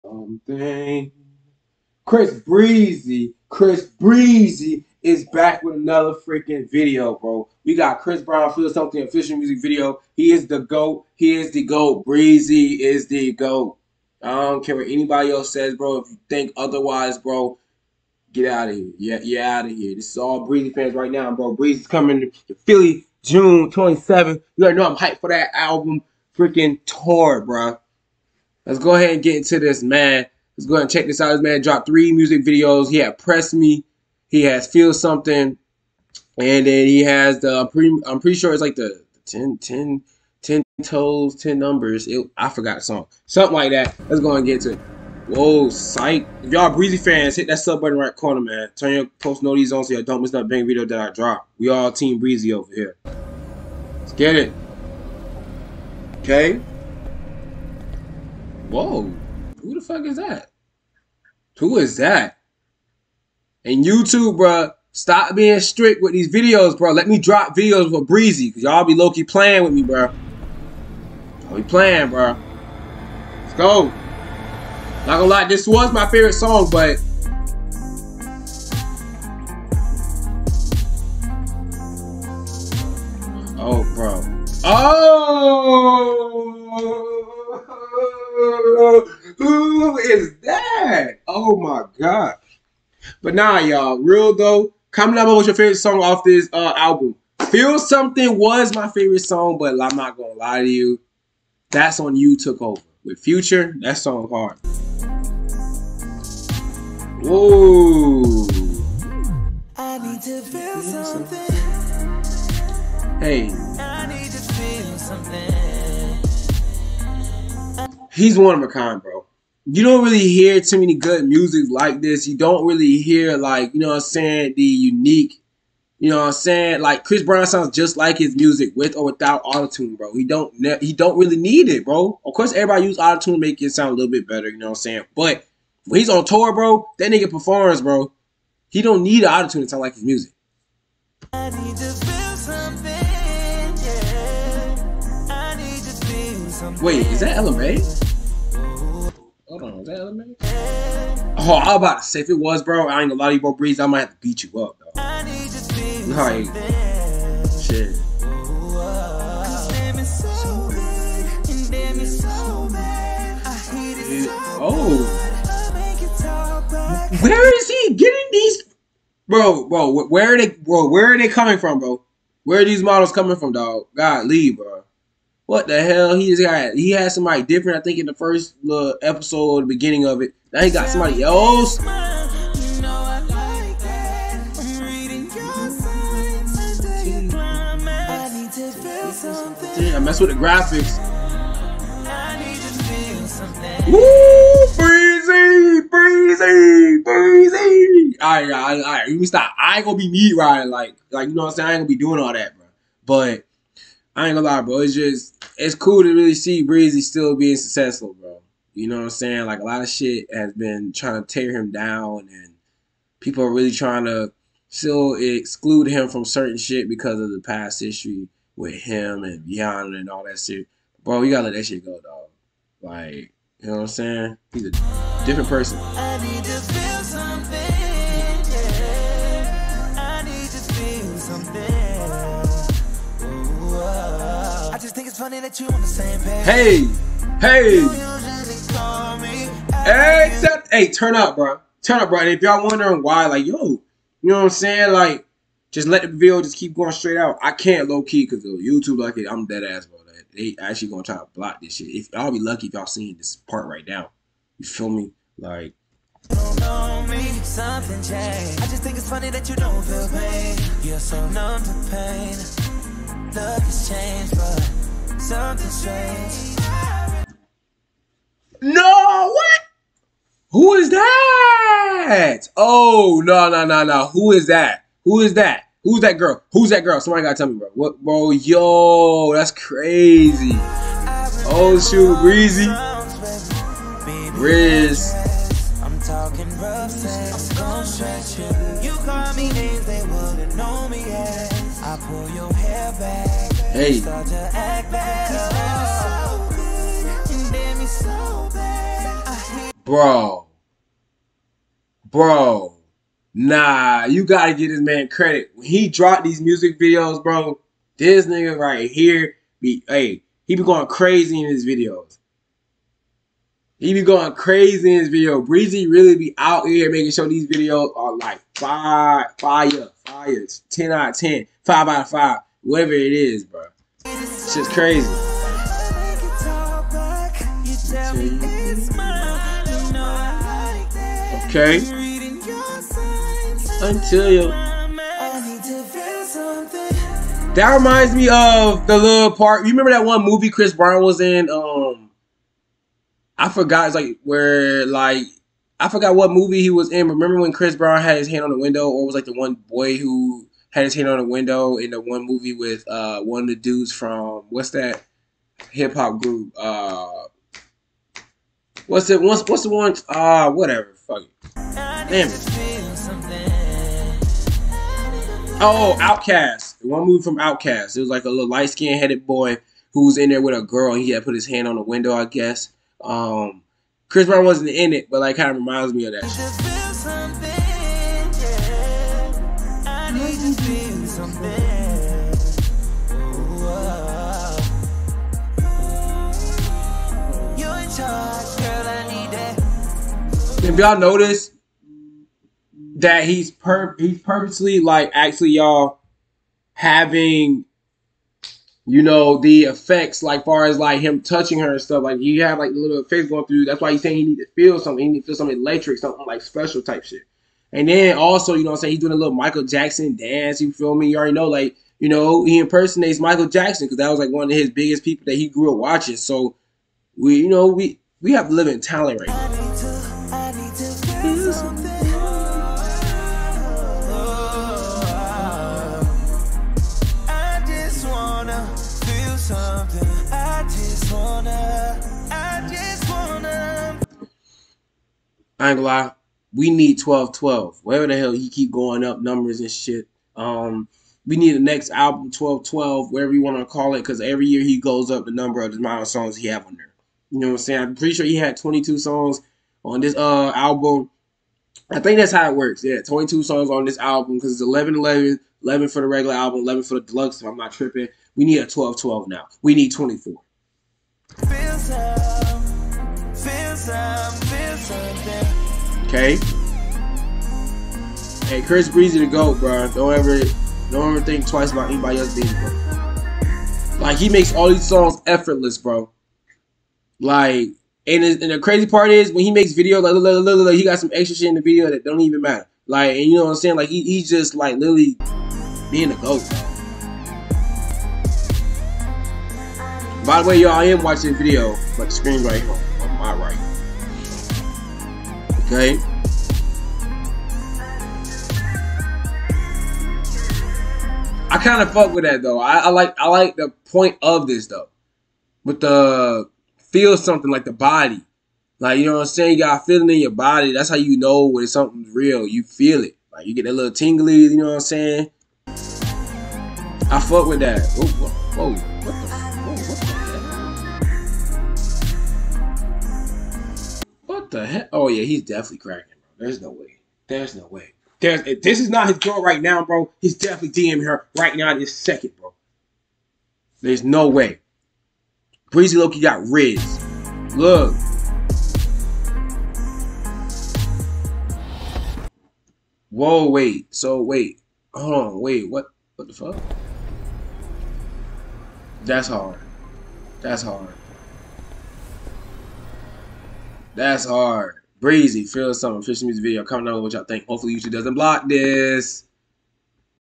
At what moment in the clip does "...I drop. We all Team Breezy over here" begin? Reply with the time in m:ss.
0:50.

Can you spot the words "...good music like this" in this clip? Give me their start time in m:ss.
2:00.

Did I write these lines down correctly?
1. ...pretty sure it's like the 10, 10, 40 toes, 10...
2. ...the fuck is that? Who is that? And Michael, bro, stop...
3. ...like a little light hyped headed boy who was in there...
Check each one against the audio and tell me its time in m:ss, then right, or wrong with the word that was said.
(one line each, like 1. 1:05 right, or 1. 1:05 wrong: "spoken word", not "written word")
1. 0:38 wrong: "10", not "40"
2. 0:59 wrong: "YouTube", not "Michael"
3. 6:08 wrong: "skinned", not "hyped".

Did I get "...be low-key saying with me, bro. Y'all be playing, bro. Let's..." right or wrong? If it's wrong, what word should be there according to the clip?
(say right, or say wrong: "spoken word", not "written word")
wrong: "playing", not "saying".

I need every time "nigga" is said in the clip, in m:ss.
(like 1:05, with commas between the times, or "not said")
2:17, 5:08.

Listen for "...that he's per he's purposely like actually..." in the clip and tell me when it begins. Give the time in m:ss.
6:32.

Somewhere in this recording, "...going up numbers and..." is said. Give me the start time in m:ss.
7:18.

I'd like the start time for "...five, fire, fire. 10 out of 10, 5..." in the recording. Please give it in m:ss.
5:18.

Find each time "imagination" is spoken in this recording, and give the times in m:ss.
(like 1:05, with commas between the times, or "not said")
not said.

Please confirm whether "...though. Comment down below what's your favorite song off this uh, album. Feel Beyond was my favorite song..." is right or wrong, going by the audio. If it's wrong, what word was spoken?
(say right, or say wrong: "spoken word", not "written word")
wrong: "Something", not "Beyond".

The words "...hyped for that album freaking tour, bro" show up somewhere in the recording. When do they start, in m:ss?
0:24.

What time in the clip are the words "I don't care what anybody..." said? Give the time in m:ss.
0:14.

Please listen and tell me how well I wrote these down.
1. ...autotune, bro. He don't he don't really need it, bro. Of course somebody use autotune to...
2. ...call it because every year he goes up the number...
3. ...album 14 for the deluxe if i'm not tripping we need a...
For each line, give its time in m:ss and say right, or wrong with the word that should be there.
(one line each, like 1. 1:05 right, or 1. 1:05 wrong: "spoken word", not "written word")
1. 2:09 wrong: "everybody", not "somebody"
2. 7:23 right
3. 7:36 wrong: "11", not "14".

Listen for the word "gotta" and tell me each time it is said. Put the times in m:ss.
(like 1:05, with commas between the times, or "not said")
3:41, 4:37, 5:04.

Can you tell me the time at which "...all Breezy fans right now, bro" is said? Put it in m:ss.
0:20.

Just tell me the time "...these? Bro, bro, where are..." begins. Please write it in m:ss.
2:48.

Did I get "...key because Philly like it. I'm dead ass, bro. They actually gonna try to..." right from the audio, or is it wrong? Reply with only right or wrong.
wrong.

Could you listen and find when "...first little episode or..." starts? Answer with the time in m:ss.
2:58.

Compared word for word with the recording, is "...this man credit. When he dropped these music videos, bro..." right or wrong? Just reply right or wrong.
right.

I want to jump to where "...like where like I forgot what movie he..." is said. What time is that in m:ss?
5:43.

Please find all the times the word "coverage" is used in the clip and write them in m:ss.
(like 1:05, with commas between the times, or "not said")
not said.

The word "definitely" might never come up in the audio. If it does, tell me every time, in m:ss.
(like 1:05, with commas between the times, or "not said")
8:45, 8:50.